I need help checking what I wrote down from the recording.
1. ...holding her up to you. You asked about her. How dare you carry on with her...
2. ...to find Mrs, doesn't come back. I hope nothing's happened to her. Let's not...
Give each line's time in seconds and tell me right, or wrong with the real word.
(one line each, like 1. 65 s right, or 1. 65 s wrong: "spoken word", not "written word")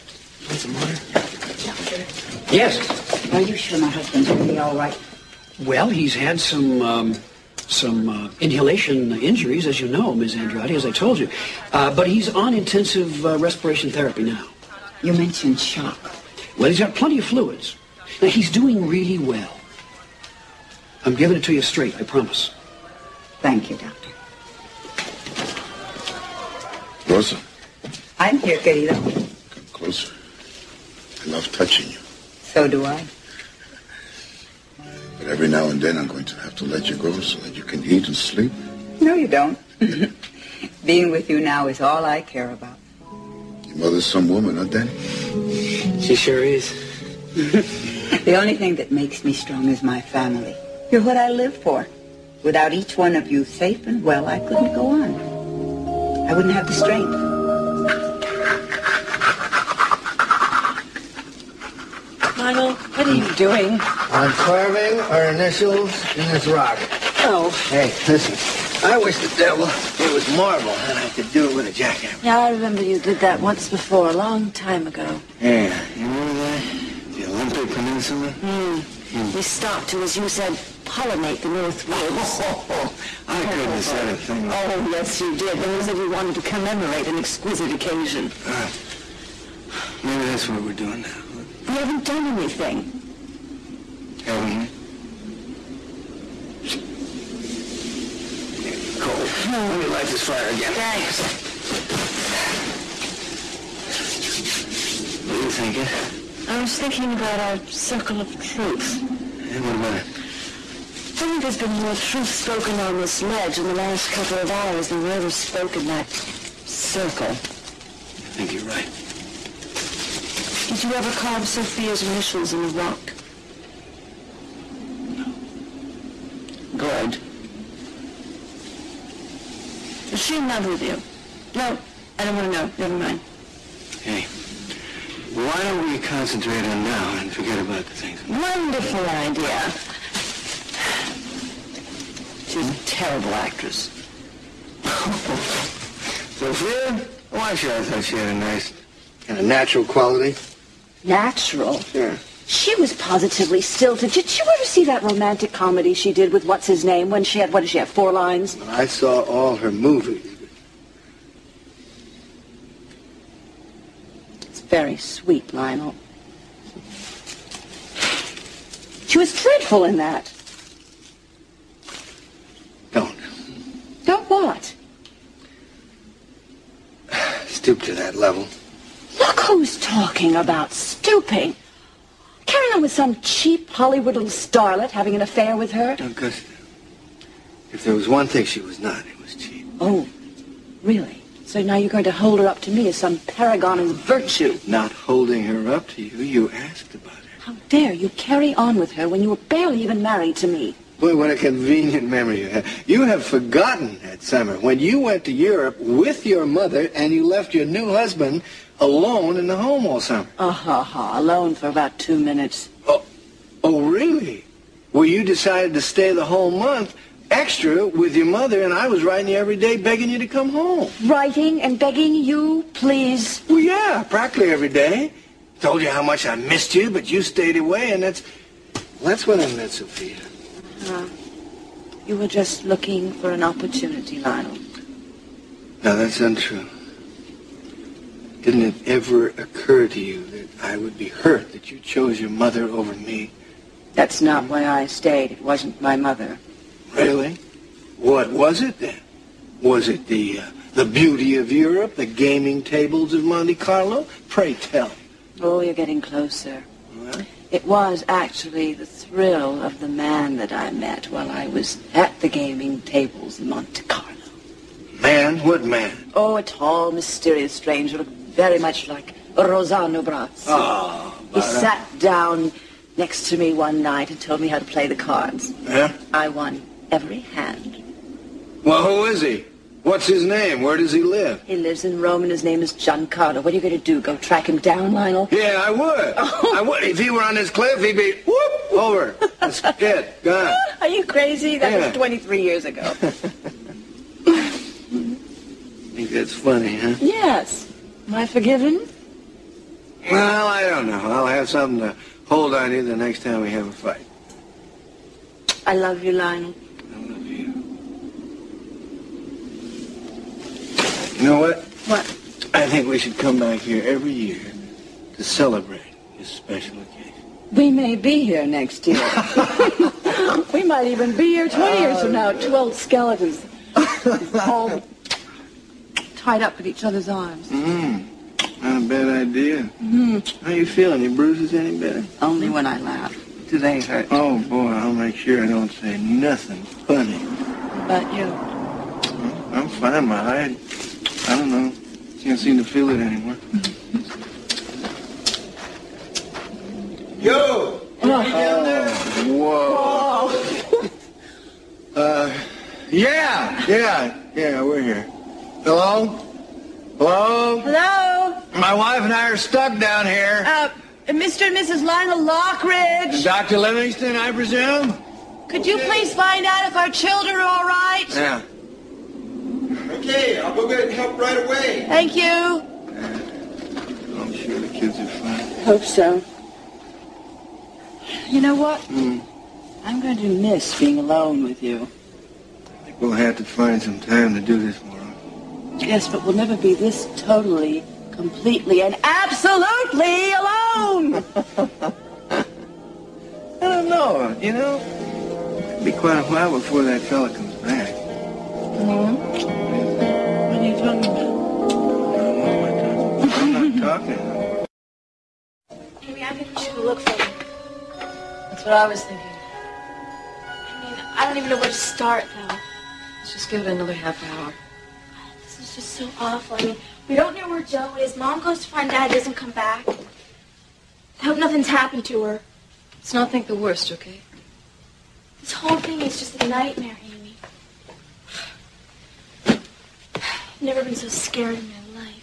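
1. 194 s right
2. 418 s wrong: "Dad", not "Mrs".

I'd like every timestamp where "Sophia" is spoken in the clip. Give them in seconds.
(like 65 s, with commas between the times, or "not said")
121 s, 146 s, 229 s.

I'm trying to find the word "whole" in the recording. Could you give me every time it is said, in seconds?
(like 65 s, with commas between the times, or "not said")
216 s, 425 s.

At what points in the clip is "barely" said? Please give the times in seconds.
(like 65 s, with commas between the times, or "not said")
199 s.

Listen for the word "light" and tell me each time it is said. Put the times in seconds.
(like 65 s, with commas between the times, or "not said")
99 s.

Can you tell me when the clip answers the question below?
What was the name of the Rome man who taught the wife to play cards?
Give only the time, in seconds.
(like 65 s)
282 s.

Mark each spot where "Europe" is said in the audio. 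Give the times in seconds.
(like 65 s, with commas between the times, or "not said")
205 s, 251 s.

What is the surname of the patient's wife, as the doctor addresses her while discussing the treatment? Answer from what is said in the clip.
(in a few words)
Andrade.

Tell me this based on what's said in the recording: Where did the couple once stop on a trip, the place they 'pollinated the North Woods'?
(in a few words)
The Olympic Peninsula.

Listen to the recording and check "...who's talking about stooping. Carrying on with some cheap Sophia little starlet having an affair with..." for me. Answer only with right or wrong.
wrong.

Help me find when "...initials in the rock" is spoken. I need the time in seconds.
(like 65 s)
122 s.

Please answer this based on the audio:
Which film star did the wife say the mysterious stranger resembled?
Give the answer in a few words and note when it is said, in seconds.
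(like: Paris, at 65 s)
Rossano Brazzi, at 269 s.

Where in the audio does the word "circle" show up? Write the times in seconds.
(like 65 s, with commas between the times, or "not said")
107 s, 116 s.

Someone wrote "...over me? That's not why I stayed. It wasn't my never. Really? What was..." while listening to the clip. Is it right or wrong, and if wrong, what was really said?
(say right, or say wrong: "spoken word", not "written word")
wrong: "mother", not "never".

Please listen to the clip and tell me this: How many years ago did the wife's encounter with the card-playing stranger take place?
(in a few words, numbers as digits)
23.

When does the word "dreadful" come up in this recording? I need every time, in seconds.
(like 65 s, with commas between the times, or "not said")
169 s.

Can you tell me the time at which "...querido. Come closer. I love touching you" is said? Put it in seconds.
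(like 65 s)
28 s.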